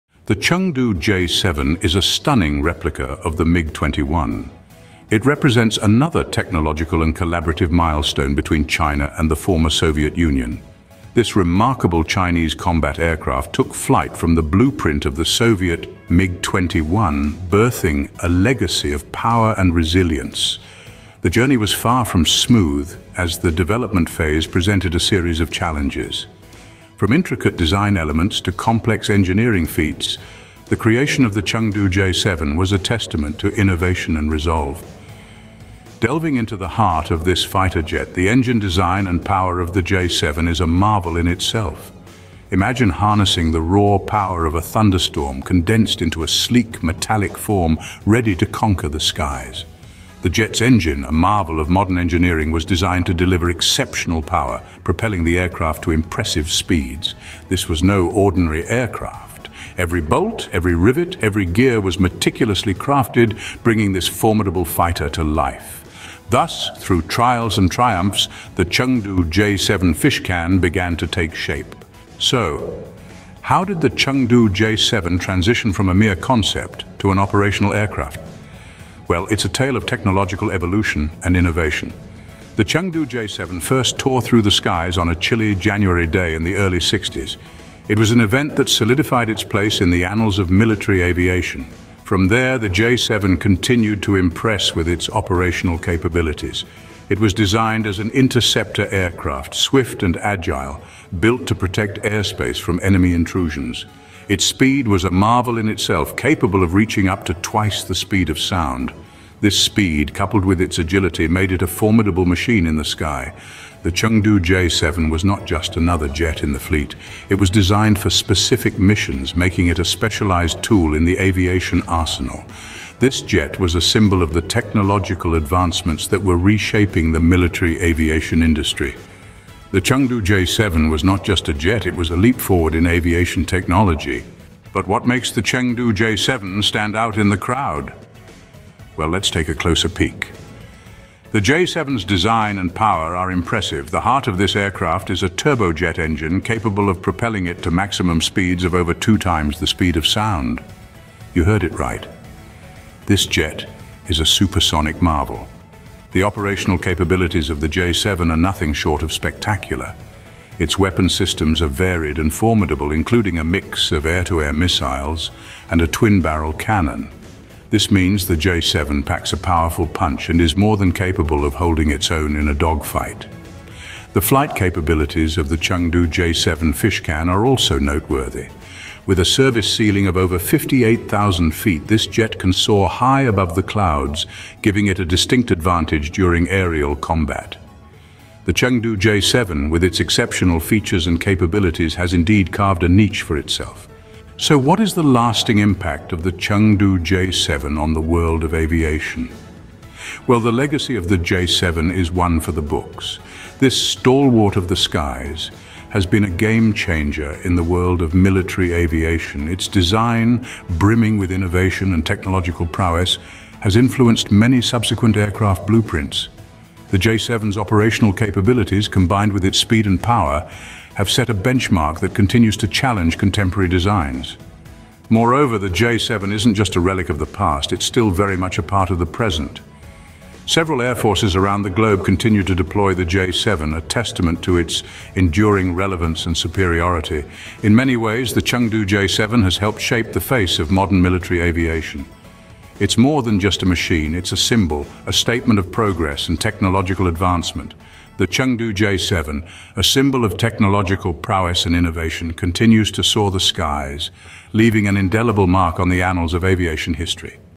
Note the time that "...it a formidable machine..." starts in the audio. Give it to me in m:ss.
1:51.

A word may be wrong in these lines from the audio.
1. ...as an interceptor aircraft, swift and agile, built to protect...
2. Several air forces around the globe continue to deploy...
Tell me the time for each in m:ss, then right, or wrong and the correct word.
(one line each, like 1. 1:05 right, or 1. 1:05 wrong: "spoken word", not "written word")
1. 1:37 right
2. 3:50 right.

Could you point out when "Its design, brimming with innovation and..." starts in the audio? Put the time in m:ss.
3:29.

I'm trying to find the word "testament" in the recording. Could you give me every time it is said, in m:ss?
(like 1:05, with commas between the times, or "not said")
0:32, 3:53.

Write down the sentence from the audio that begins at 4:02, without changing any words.
It's more than just a machine, it's a symbol, a statement of progress and technological advancement.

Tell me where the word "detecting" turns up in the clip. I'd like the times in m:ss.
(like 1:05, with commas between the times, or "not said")
not said.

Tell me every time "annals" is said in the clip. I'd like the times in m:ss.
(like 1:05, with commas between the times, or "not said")
1:30, 4:16.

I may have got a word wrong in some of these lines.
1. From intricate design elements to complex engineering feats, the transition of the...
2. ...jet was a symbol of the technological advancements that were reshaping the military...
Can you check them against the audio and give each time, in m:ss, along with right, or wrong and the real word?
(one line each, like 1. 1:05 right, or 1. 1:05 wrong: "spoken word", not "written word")
1. 0:27 wrong: "creation", not "transition"
2. 2:03 right.